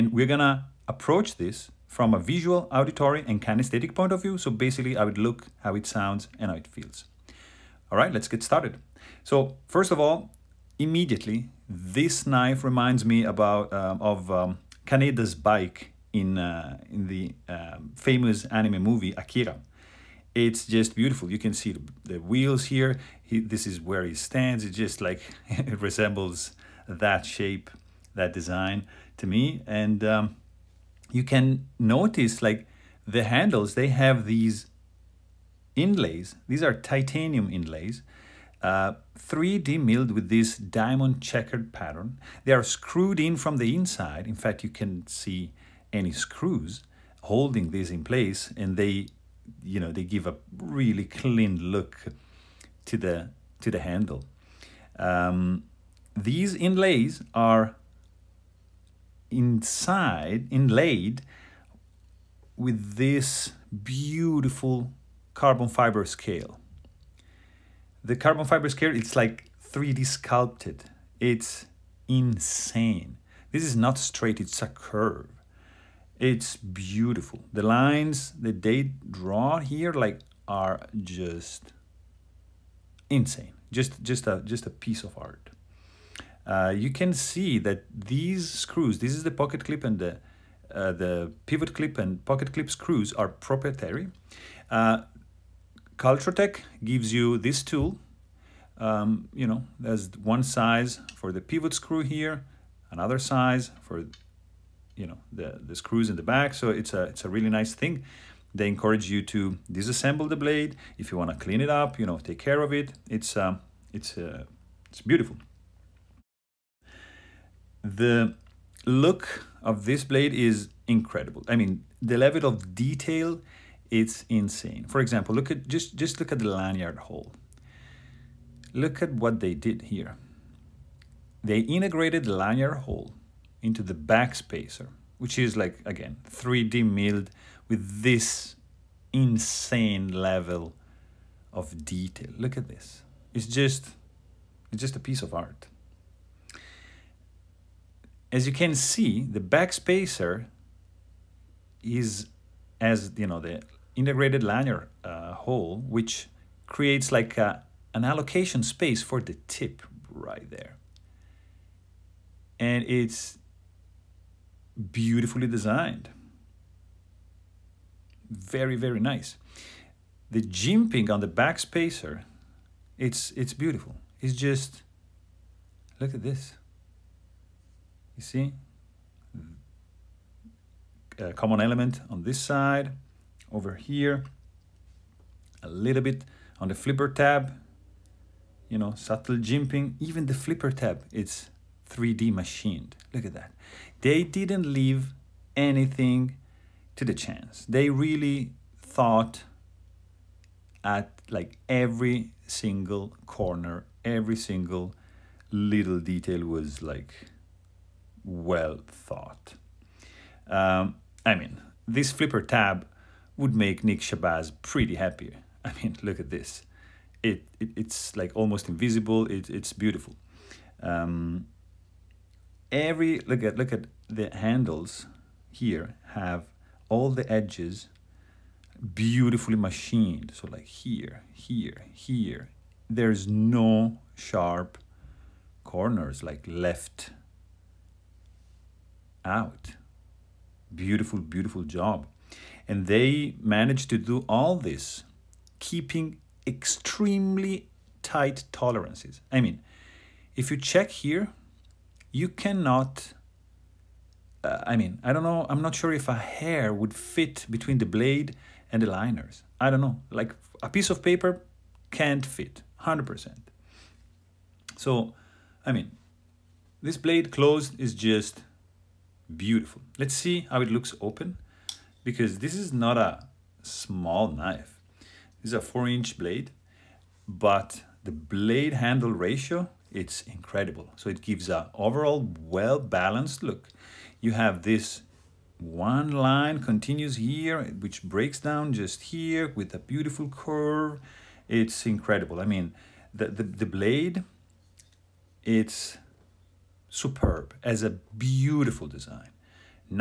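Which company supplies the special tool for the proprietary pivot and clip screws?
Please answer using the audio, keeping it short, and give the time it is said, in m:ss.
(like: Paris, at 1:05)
Cultrotech, at 1:36.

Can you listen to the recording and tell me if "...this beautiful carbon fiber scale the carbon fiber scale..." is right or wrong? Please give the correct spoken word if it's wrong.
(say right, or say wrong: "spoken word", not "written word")
right.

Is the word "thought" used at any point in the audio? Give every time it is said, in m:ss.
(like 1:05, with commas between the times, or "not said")
3:18, 3:28.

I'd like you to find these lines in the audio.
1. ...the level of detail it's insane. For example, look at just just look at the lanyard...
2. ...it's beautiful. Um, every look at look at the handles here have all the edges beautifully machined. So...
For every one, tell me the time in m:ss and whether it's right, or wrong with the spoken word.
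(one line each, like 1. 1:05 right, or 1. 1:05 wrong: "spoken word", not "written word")
1. 2:02 right
2. 3:39 right.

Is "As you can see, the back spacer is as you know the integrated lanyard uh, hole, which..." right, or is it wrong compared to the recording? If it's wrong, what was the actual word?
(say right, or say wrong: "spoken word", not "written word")
right.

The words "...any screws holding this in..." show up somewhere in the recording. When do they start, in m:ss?
0:45.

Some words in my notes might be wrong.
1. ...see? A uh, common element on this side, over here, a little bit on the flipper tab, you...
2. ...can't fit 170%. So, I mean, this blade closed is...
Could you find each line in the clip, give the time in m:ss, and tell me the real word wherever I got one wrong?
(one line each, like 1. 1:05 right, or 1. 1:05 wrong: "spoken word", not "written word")
1. 2:58 right
2. 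4:21 wrong: "100", not "170".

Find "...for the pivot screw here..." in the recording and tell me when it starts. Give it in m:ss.
1:41.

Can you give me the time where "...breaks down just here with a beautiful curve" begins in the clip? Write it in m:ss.
4:48.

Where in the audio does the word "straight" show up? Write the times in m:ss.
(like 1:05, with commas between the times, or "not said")
1:13.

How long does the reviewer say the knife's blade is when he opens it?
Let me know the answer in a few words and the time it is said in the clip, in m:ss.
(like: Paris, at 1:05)
4 inches, at 4:35.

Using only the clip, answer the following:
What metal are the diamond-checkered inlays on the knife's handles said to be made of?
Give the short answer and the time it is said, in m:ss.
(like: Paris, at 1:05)
Titanium, at 0:36.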